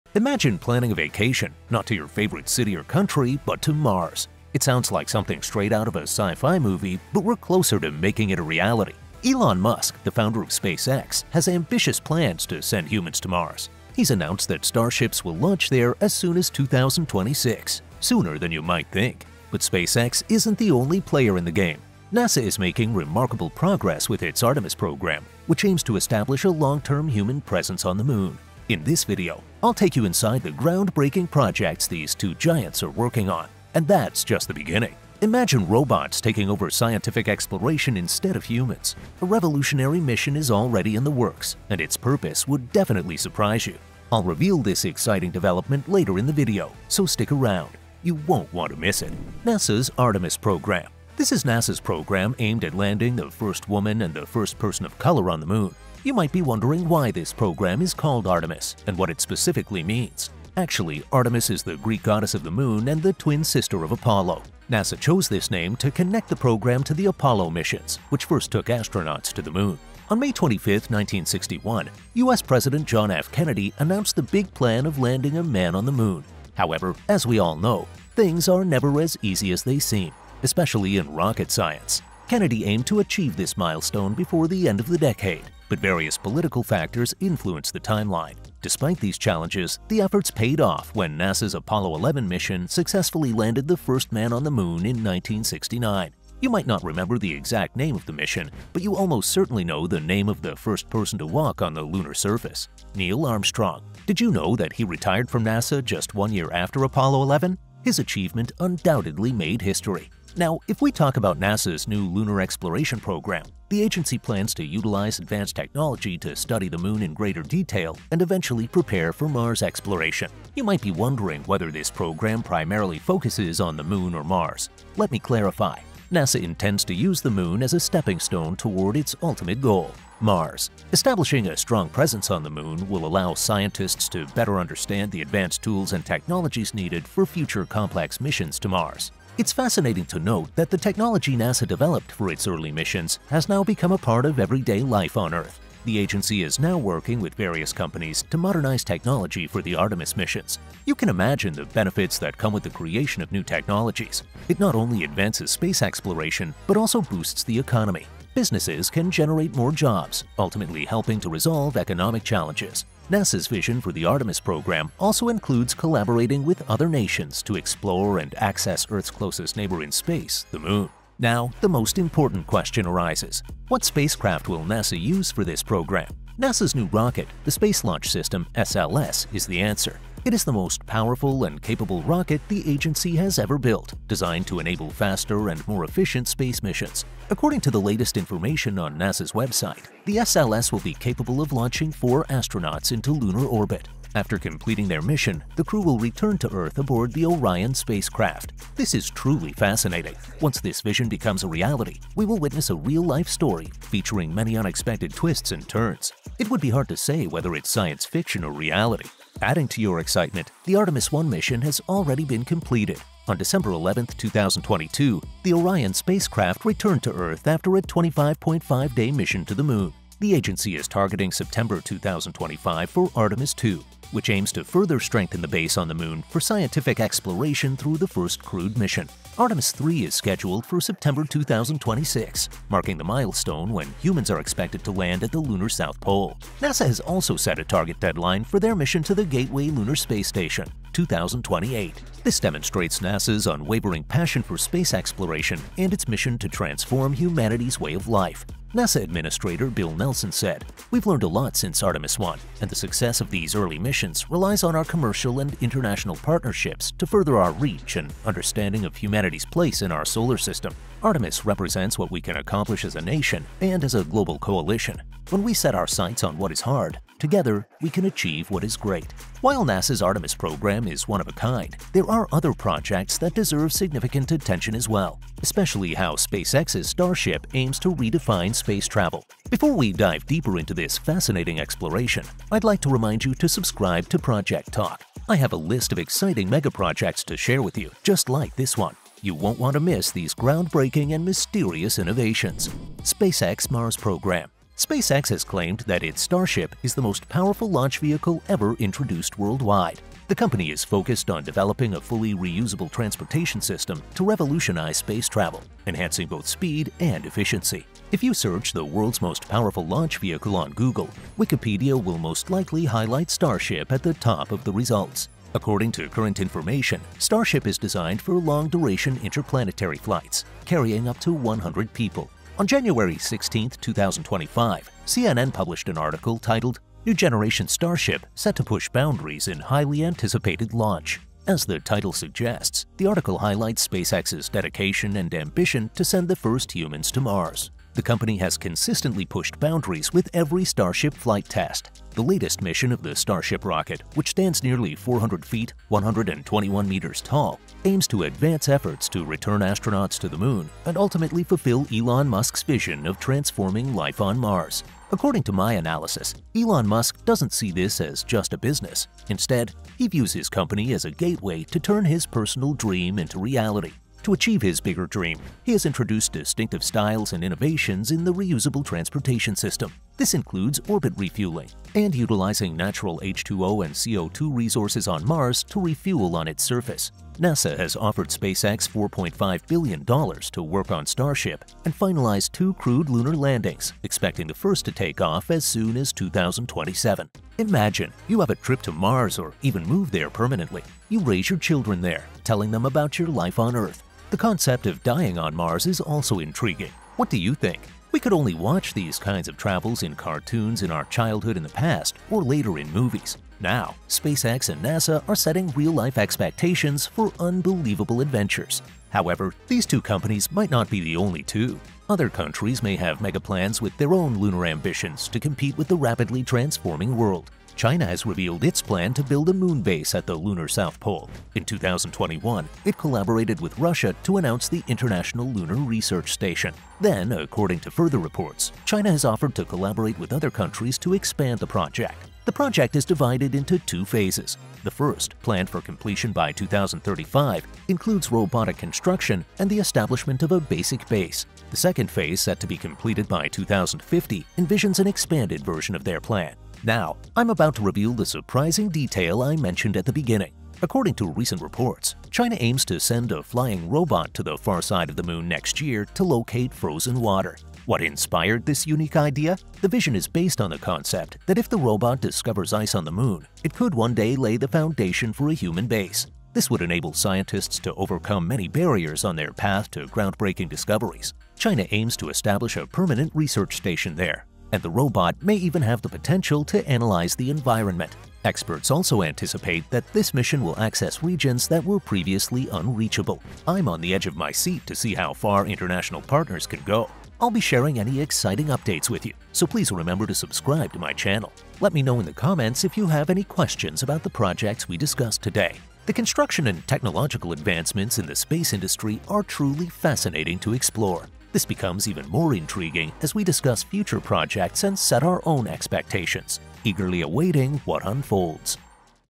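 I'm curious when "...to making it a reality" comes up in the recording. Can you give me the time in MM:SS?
00:07.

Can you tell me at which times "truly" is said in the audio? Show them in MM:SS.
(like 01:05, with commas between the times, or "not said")
03:19, 08:19.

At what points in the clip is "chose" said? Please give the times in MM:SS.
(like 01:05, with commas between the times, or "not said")
01:04.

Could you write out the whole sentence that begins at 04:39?
Before we dive deeper into this fascinating exploration, I'd like to remind you to subscribe to ProjecTalk.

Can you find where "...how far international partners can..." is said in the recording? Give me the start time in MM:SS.
08:05.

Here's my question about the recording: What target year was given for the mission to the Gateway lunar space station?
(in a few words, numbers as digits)
2028.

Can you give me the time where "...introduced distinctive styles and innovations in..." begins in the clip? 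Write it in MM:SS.
06:05.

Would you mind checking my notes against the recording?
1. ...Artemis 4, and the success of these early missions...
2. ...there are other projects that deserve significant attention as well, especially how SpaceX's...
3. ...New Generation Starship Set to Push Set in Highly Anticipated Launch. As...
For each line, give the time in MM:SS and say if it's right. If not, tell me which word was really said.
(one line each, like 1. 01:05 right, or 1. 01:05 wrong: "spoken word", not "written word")
1. 04:11 wrong: "1", not "4"
2. 04:31 right
3. 05:27 wrong: "Boundaries", not "Set".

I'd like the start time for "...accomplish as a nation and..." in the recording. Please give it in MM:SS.
04:22.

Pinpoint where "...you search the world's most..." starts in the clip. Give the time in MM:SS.
05:08.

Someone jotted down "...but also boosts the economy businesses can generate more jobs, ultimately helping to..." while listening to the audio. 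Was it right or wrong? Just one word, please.
right.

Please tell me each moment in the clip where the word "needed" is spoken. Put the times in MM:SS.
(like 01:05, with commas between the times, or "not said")
02:16.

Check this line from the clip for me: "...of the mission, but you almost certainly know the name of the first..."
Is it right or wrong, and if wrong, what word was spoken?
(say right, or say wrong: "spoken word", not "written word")
right.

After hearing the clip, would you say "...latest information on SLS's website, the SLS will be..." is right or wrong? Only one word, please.
wrong.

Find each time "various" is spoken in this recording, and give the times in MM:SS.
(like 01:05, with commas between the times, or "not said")
01:25, 02:27.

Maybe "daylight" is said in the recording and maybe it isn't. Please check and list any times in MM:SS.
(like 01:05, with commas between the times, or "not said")
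not said.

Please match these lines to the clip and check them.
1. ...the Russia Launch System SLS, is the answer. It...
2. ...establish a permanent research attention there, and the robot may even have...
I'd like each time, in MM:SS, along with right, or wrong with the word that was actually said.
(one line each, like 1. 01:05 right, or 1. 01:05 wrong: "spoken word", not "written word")
1. 02:57 wrong: "Space", not "Russia"
2. 07:52 wrong: "station", not "attention".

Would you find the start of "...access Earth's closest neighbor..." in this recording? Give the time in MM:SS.
02:48.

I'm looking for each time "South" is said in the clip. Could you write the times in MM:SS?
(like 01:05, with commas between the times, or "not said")
03:55, 07:00.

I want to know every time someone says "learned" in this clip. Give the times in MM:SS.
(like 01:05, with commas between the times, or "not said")
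04:11.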